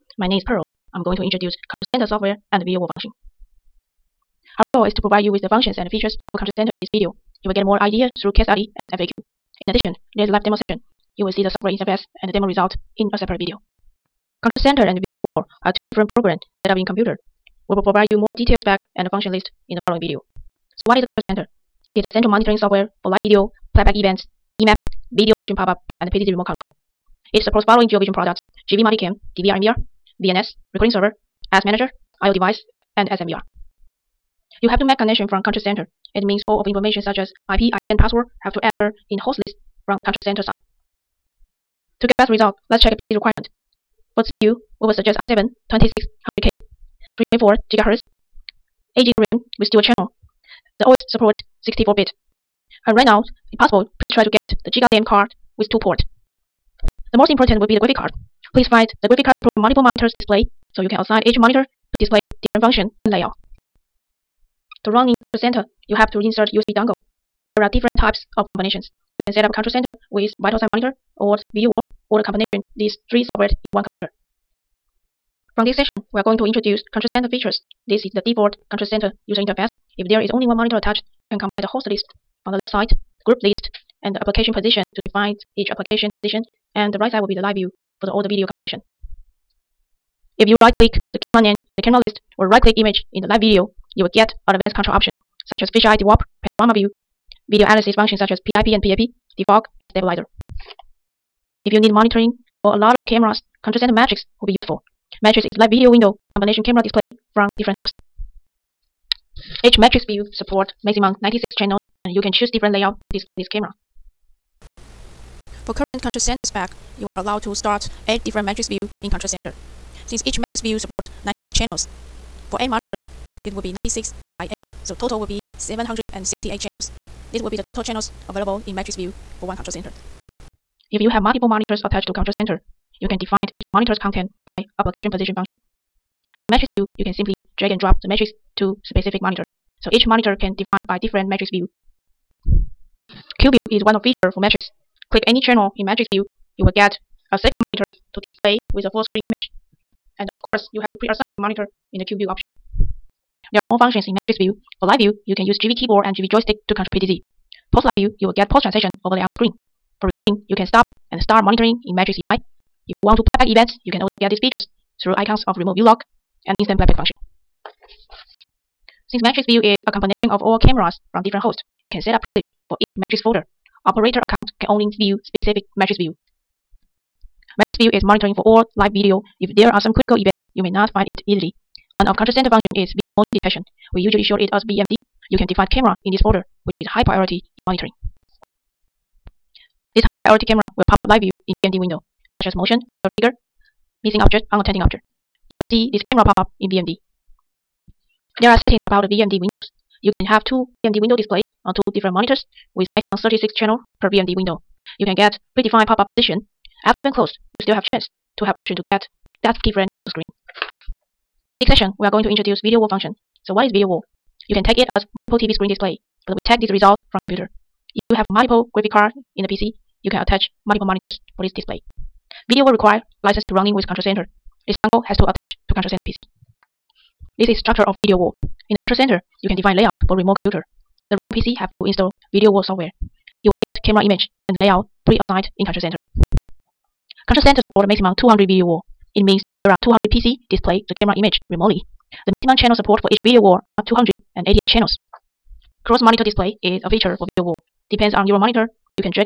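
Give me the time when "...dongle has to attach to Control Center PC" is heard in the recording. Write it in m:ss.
3:44.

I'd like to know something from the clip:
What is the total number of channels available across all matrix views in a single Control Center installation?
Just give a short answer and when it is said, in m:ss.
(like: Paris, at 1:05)
768, at 2:05.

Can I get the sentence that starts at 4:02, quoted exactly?
The maximum channel support for each video wall are 288 channels.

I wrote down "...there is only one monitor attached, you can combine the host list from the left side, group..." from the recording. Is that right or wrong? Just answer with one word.
right.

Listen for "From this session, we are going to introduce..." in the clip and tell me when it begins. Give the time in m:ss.
1:15.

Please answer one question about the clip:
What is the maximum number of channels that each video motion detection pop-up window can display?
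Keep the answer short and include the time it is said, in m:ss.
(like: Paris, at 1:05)
36, at 3:23.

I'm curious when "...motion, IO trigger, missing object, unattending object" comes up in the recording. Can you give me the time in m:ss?
3:12.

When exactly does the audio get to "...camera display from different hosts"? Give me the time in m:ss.
1:46.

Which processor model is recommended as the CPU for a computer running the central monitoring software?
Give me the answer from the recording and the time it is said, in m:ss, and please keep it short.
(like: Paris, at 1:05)
i7 2600K, at 0:45.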